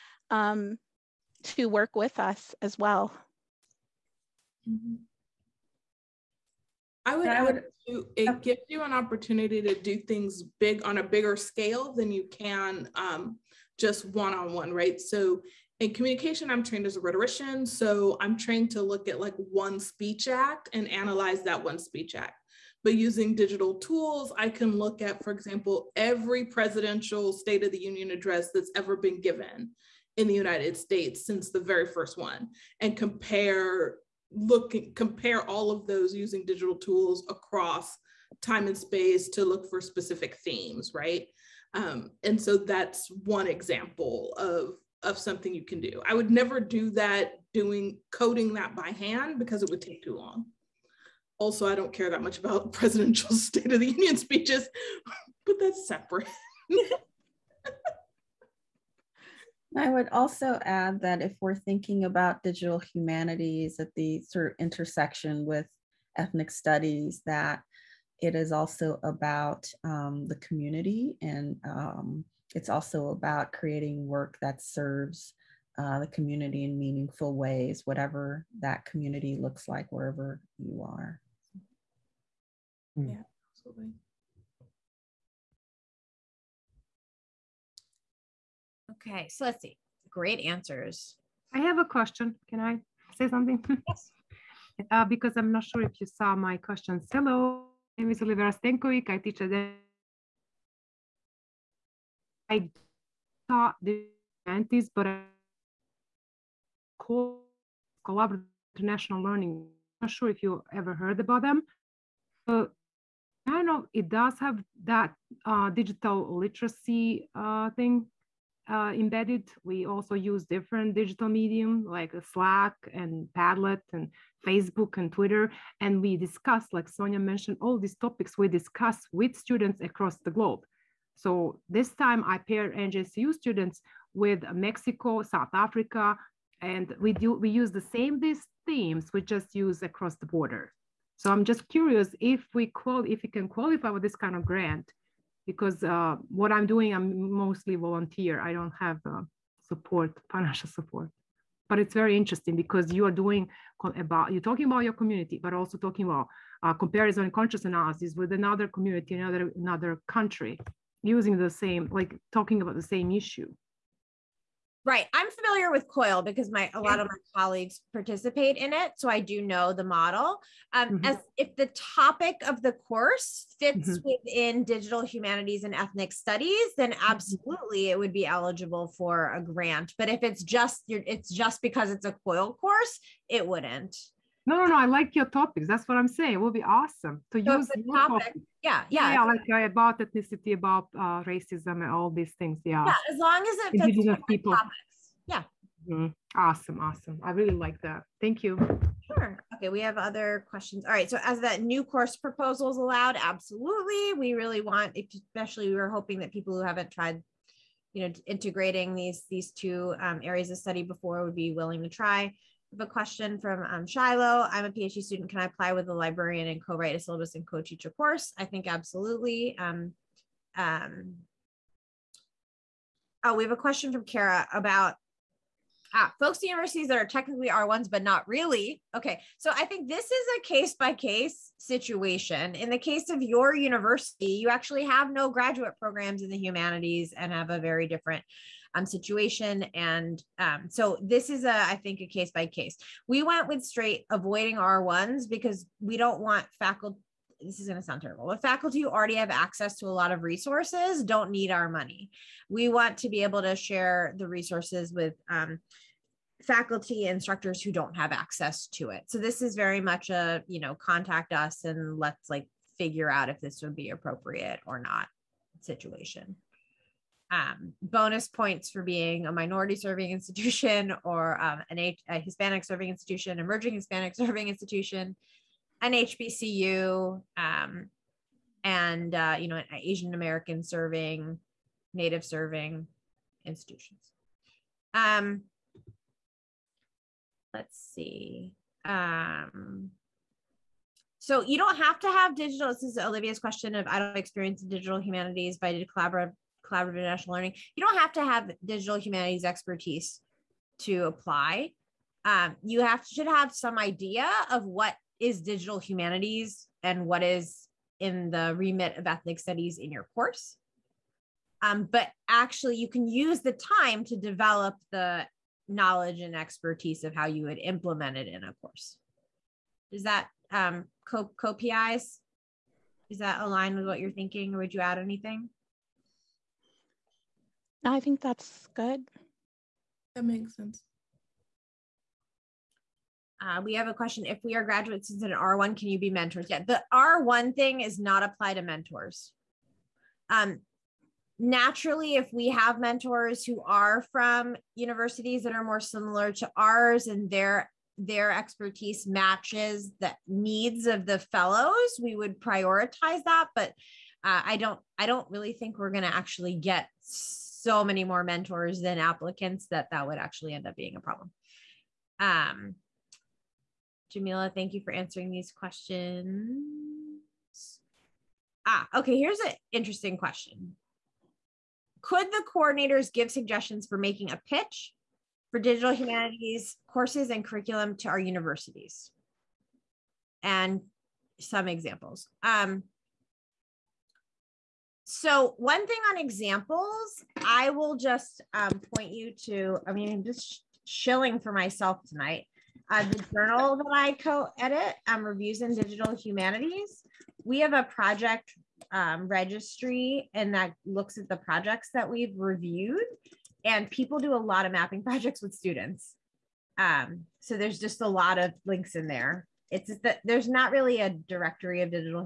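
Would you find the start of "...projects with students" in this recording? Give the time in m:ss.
6:45.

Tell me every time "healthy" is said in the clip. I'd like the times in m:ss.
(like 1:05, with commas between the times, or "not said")
not said.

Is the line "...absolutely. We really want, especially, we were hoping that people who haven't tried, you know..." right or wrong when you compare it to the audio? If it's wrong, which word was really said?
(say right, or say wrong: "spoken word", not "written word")
right.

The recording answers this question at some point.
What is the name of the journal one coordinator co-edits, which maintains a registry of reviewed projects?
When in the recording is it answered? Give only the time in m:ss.
6:35.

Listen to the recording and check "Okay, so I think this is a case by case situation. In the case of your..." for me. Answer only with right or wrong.
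right.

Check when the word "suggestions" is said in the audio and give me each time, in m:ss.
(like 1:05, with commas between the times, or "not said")
6:13.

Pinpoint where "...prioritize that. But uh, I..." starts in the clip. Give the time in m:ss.
5:52.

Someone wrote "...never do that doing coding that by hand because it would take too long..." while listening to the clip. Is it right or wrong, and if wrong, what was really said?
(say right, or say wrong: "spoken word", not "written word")
right.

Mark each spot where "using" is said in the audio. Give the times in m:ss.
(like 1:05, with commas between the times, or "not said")
0:22, 0:36, 2:41.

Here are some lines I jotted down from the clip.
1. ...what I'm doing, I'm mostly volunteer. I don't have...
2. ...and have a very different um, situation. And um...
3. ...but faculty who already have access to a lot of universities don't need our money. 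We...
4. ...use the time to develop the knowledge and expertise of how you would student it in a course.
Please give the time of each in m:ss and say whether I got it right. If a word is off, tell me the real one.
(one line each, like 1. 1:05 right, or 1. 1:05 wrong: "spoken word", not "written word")
1. 2:26 right
2. 3:57 right
3. 4:08 wrong: "resources", not "universities"
4. 5:13 wrong: "implement", not "student".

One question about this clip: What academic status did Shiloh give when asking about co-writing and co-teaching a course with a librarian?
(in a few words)
PhD student.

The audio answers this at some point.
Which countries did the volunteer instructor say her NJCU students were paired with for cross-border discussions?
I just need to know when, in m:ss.
2:14.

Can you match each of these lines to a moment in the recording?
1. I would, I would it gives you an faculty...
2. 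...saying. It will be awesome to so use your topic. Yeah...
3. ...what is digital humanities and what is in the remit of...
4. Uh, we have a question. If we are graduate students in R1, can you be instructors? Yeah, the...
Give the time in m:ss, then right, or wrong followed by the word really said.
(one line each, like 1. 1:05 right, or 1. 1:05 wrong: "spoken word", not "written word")
1. 0:07 wrong: "opportunity", not "faculty"
2. 3:06 right
3. 5:04 right
4. 5:33 wrong: "mentors", not "instructors".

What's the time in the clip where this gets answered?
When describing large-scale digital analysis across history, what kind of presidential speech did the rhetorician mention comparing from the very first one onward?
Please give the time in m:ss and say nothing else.
0:27.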